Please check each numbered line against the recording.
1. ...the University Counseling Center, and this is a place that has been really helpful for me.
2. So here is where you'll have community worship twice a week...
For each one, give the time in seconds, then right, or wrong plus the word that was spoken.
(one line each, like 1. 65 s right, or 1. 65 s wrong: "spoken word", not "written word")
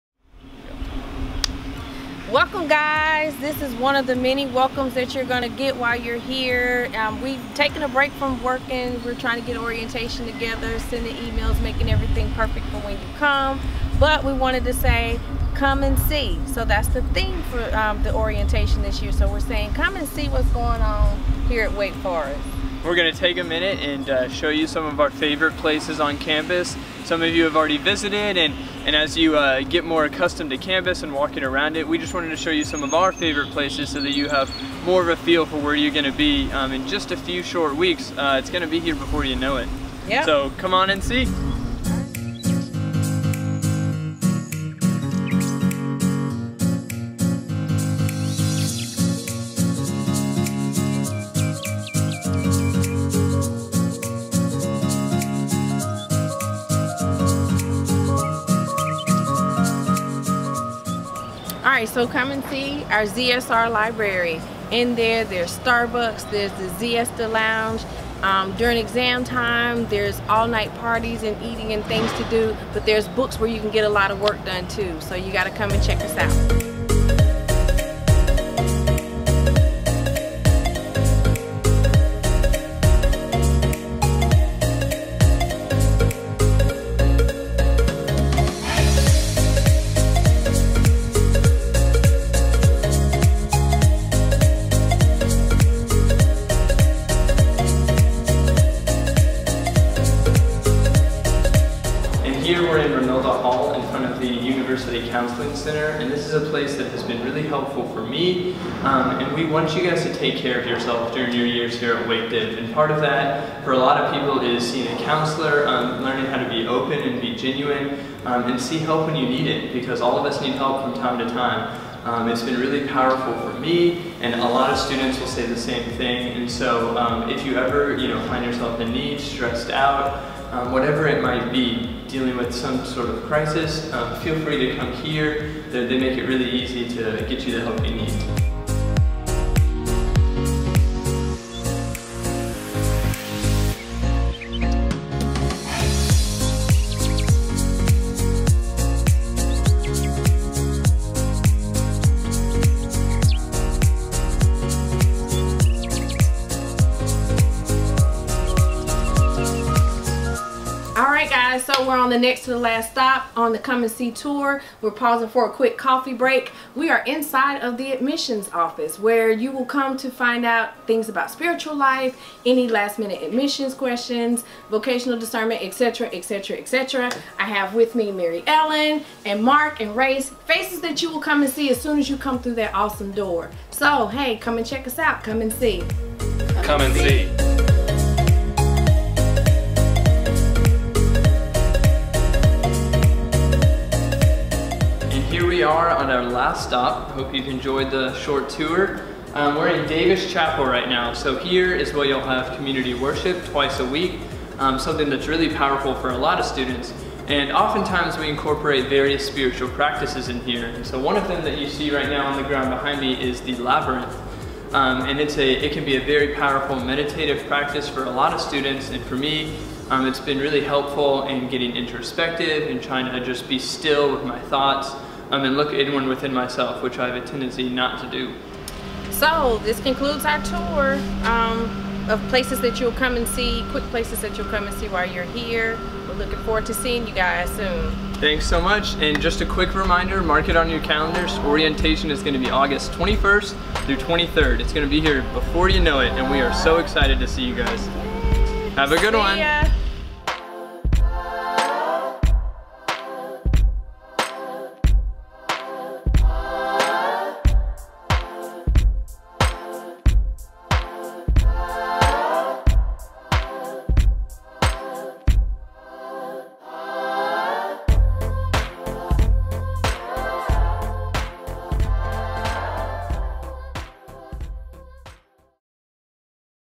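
1. 104 s right
2. 201 s right.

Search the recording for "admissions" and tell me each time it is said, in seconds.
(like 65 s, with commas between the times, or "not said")
167 s, 173 s.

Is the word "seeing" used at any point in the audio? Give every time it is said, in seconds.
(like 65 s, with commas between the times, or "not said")
114 s, 236 s.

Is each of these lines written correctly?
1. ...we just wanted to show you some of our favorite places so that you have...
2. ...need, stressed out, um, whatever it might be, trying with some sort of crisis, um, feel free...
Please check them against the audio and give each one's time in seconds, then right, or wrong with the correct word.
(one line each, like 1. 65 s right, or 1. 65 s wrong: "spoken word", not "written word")
1. 31 s right
2. 128 s wrong: "dealing", not "trying".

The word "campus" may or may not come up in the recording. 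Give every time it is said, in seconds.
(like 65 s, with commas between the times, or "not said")
26 s, 30 s.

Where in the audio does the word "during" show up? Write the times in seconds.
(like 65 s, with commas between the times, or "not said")
68 s, 111 s.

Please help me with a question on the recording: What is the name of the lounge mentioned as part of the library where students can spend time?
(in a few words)
Zesta lounge.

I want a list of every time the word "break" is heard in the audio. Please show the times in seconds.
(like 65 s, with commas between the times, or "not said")
7 s, 166 s.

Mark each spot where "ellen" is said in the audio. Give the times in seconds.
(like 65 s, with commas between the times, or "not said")
178 s.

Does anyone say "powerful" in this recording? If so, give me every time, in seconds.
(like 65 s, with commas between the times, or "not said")
122 s, 205 s, 216 s.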